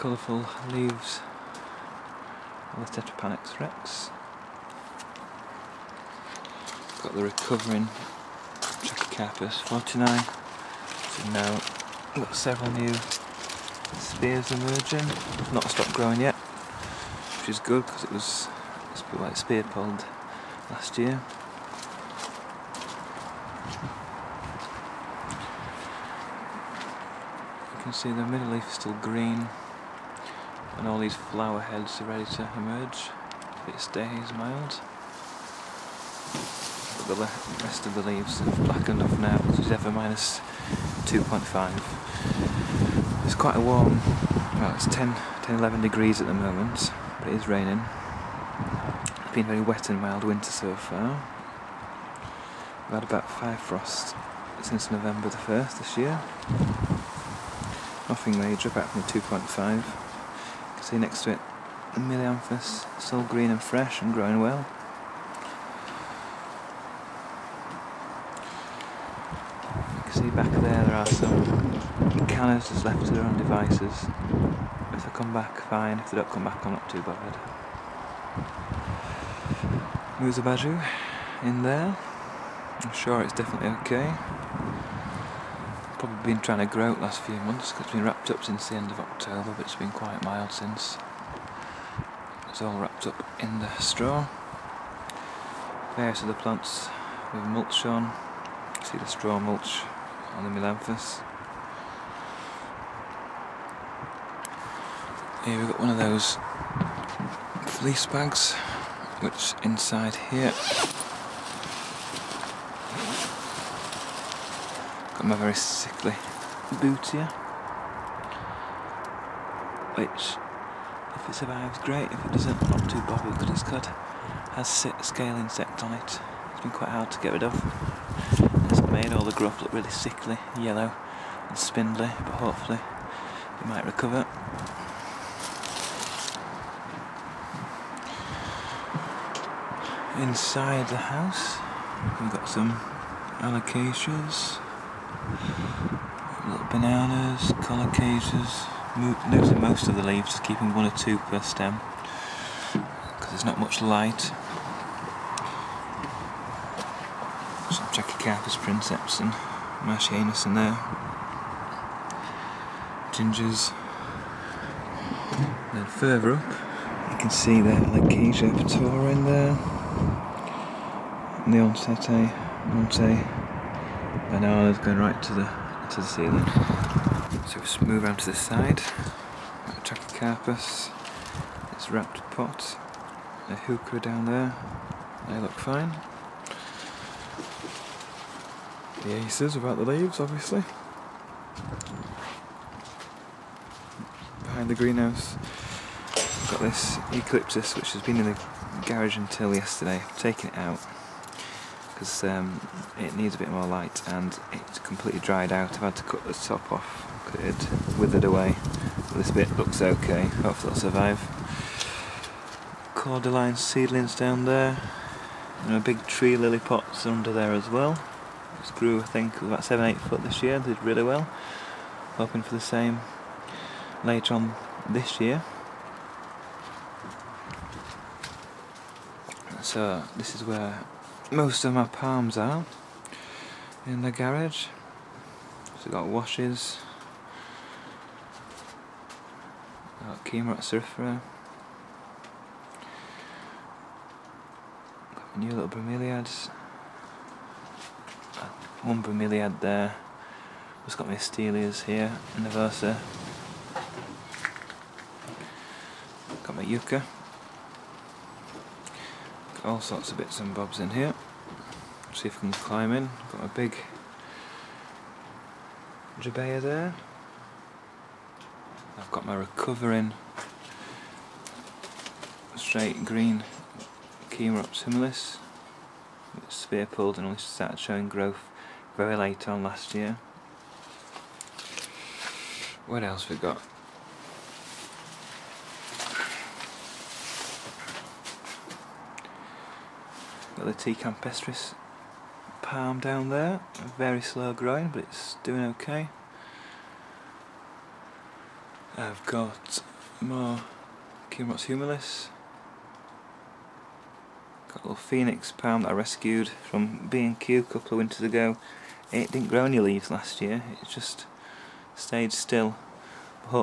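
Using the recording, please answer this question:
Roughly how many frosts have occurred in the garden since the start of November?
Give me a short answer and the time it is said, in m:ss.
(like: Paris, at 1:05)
5, at 0:53.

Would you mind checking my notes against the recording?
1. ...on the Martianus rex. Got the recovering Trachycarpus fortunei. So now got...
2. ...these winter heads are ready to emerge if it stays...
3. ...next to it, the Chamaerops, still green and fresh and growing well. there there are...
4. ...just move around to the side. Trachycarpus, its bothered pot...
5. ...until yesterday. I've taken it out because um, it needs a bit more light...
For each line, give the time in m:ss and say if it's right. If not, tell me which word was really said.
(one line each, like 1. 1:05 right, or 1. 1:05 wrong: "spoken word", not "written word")
1. 0:02 wrong: "Tetrapanax", not "Martianus"
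2. 0:30 wrong: "flower", not "winter"
3. 1:00 wrong: "Melianthus", not "Chamaerops"
4. 2:57 wrong: "wrapped", not "bothered"
5. 3:19 right.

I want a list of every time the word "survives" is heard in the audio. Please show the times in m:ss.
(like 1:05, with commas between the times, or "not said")
2:01, 3:30.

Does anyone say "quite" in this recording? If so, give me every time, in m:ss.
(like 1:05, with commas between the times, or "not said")
0:43, 1:29, 2:06.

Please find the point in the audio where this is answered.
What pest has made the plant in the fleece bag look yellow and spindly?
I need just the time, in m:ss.
2:05.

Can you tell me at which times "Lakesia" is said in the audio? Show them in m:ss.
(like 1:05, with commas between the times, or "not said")
2:47.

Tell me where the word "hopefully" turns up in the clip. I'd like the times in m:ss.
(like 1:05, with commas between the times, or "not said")
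2:12, 3:30.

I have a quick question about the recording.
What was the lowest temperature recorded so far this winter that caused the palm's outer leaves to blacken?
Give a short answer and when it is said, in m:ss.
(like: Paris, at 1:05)
-2.5, at 0:39.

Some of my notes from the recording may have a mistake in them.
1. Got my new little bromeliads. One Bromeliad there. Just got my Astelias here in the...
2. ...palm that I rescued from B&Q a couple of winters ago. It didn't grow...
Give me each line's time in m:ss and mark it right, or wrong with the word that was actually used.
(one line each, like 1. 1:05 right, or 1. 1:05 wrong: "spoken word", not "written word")
1. 4:05 right
2. 5:05 right.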